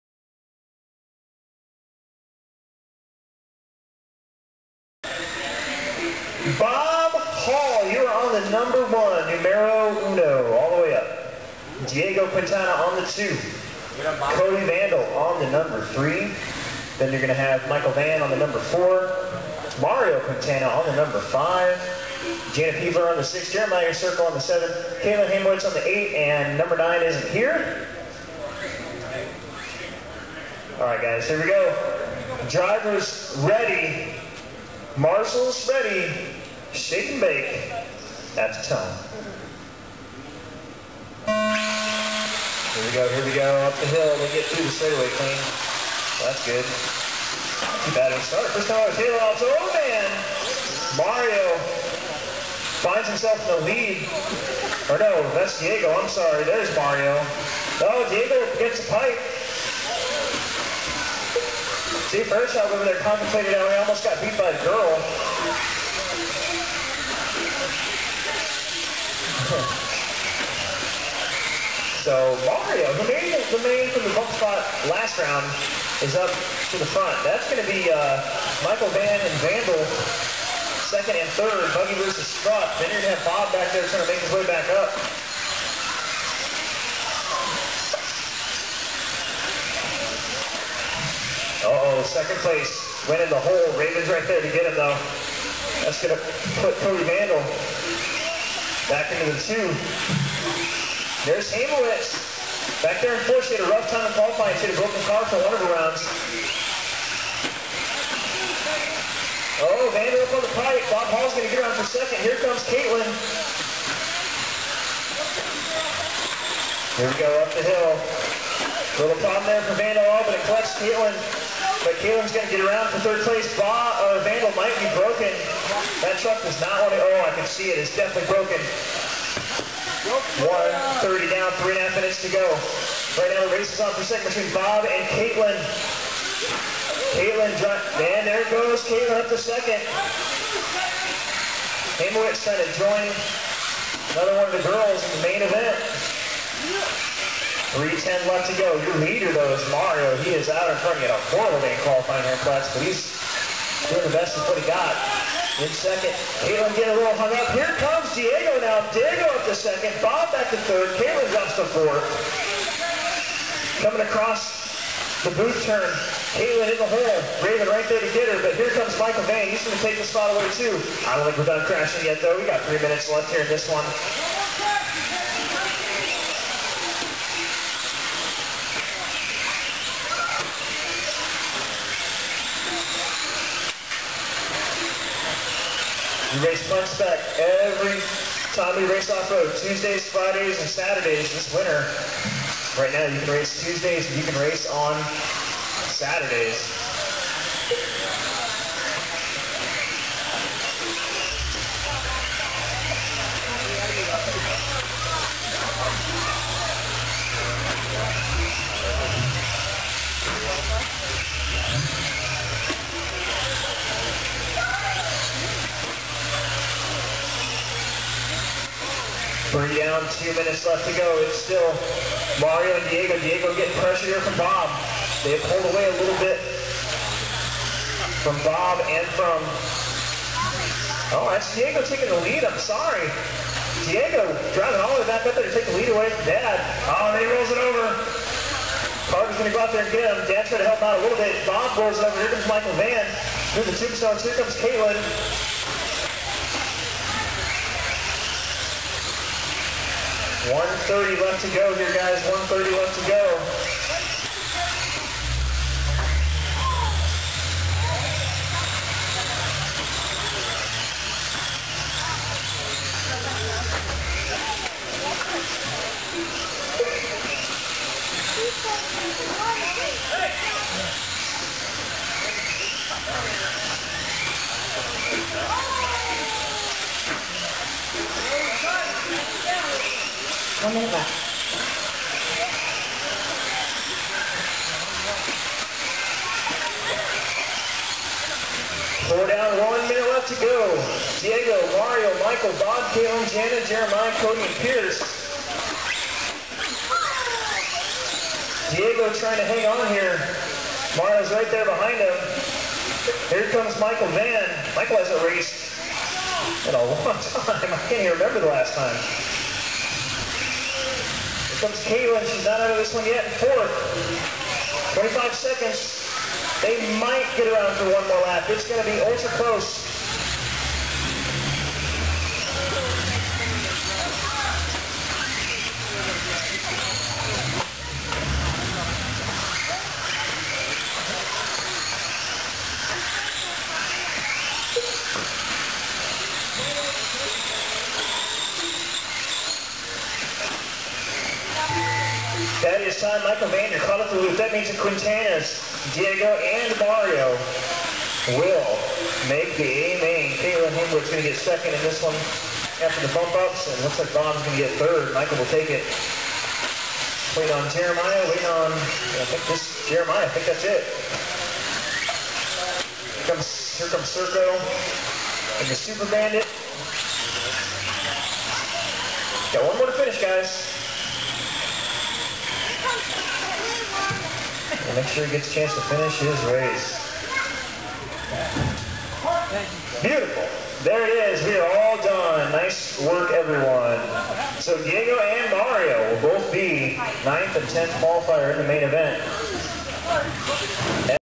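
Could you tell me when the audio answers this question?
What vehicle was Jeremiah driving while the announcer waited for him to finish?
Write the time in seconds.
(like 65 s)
365 s.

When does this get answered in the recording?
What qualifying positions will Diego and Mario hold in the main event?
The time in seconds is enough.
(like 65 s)
387 s.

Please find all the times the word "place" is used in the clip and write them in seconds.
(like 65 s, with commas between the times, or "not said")
92 s, 123 s.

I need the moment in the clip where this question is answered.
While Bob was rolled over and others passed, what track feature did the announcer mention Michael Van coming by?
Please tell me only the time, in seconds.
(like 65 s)
243 s.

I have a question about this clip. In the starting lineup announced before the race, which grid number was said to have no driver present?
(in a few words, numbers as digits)
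9.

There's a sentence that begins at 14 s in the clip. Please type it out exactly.
Cody Vandal on the number three.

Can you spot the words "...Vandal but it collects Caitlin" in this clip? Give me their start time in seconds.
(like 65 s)
119 s.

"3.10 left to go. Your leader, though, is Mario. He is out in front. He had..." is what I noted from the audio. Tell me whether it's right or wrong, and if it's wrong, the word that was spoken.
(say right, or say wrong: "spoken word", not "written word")
right.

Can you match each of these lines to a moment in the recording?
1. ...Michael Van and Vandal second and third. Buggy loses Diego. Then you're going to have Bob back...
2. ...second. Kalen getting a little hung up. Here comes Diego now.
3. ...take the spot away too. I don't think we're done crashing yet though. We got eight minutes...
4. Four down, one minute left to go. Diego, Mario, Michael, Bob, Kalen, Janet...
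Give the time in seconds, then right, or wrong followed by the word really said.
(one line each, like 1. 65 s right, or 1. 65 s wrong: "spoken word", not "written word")
1. 78 s wrong: "Strutt", not "Diego"
2. 155 s right
3. 169 s wrong: "three", not "eight"
4. 289 s right.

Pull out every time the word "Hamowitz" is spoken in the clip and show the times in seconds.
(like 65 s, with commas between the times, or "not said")
25 s, 142 s.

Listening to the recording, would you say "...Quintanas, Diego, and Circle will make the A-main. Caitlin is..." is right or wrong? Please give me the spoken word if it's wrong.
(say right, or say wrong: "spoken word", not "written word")
wrong: "Mario", not "Circle".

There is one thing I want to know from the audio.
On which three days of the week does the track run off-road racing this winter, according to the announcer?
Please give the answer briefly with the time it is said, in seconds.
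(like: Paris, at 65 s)
Tuesdays, Fridays, and Saturdays, at 189 s.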